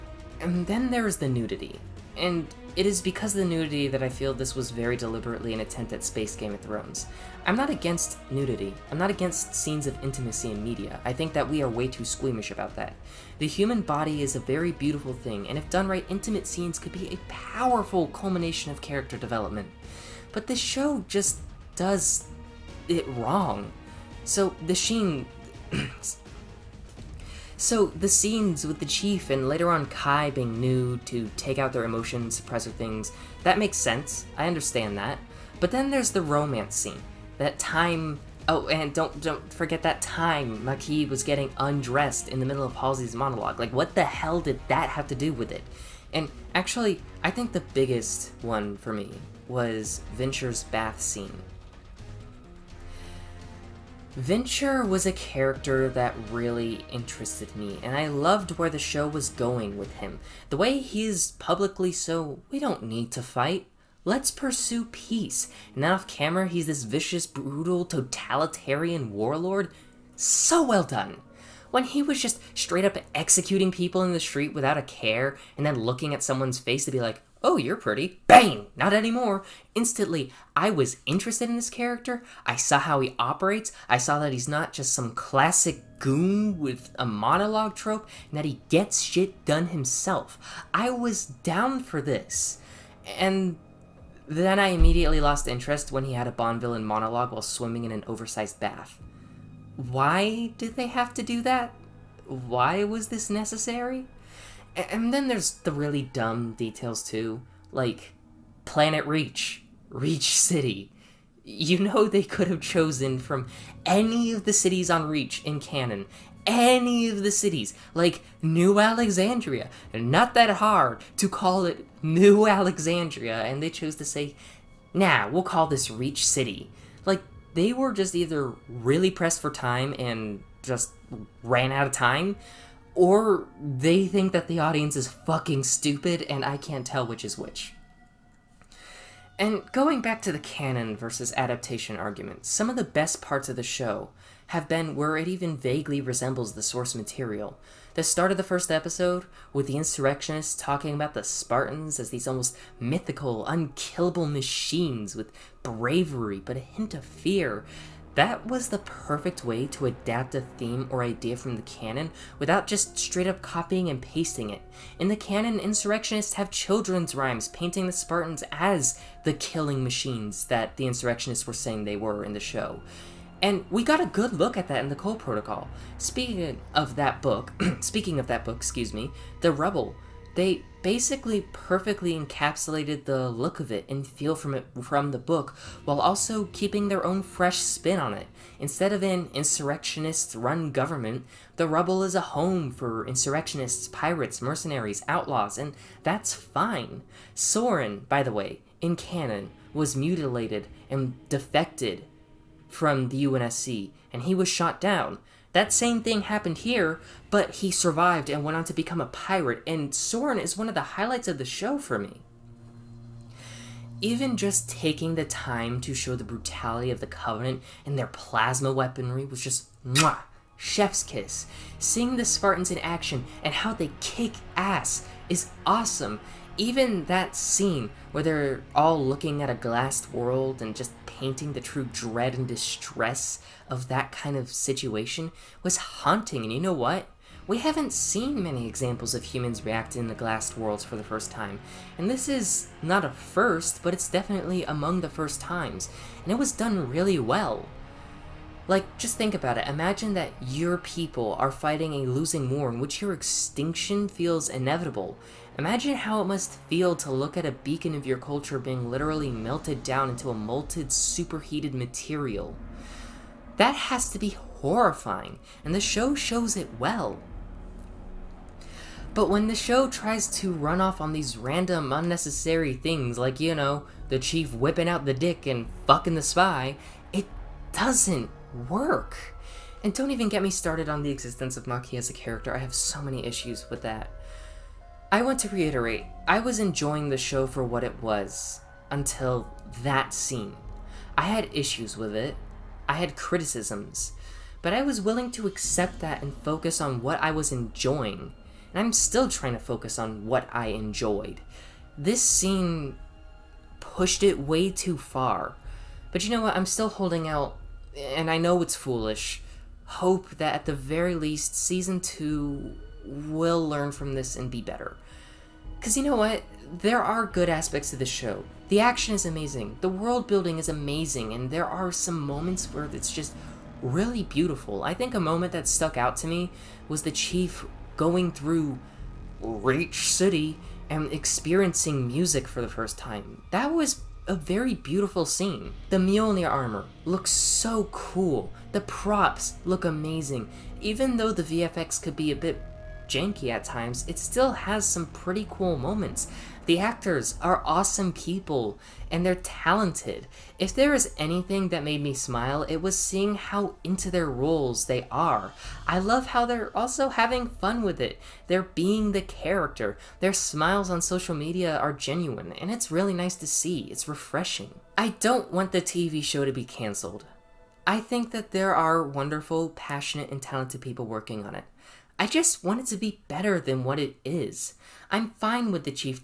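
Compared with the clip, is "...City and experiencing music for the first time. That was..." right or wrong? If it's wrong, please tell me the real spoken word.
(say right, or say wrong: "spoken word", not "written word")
right.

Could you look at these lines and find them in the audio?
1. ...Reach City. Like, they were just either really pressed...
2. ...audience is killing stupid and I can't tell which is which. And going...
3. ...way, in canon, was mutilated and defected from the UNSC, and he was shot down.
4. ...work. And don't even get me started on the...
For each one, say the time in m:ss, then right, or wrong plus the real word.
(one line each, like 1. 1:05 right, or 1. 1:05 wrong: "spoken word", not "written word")
1. 2:05 right
2. 2:14 wrong: "fucking", not "killing"
3. 3:18 right
4. 4:38 right.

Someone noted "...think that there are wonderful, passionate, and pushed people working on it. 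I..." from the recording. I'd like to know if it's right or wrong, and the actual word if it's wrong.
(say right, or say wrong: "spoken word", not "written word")
wrong: "talented", not "pushed".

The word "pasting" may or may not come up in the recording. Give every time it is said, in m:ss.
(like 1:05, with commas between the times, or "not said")
2:44.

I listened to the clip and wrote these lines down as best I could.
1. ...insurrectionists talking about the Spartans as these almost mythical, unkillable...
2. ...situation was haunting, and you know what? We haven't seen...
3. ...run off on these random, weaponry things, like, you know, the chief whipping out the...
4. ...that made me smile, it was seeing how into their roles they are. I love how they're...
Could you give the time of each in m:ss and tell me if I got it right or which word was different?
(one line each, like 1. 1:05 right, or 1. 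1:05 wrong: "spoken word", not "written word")
1. 2:29 right
2. 3:54 right
3. 4:30 wrong: "unnecessary", not "weaponry"
4. 5:51 right.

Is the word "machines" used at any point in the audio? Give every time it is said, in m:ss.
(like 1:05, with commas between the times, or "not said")
2:34, 2:49.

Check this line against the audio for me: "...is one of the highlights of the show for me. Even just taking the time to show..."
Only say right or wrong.
right.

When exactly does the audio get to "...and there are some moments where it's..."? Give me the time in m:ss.
5:21.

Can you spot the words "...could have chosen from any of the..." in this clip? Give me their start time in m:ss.
1:52.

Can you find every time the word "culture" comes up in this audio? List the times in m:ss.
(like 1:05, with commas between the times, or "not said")
4:18.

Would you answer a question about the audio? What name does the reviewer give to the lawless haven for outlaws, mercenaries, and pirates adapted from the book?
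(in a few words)
The Rubble.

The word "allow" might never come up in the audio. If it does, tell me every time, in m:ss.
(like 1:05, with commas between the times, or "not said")
not said.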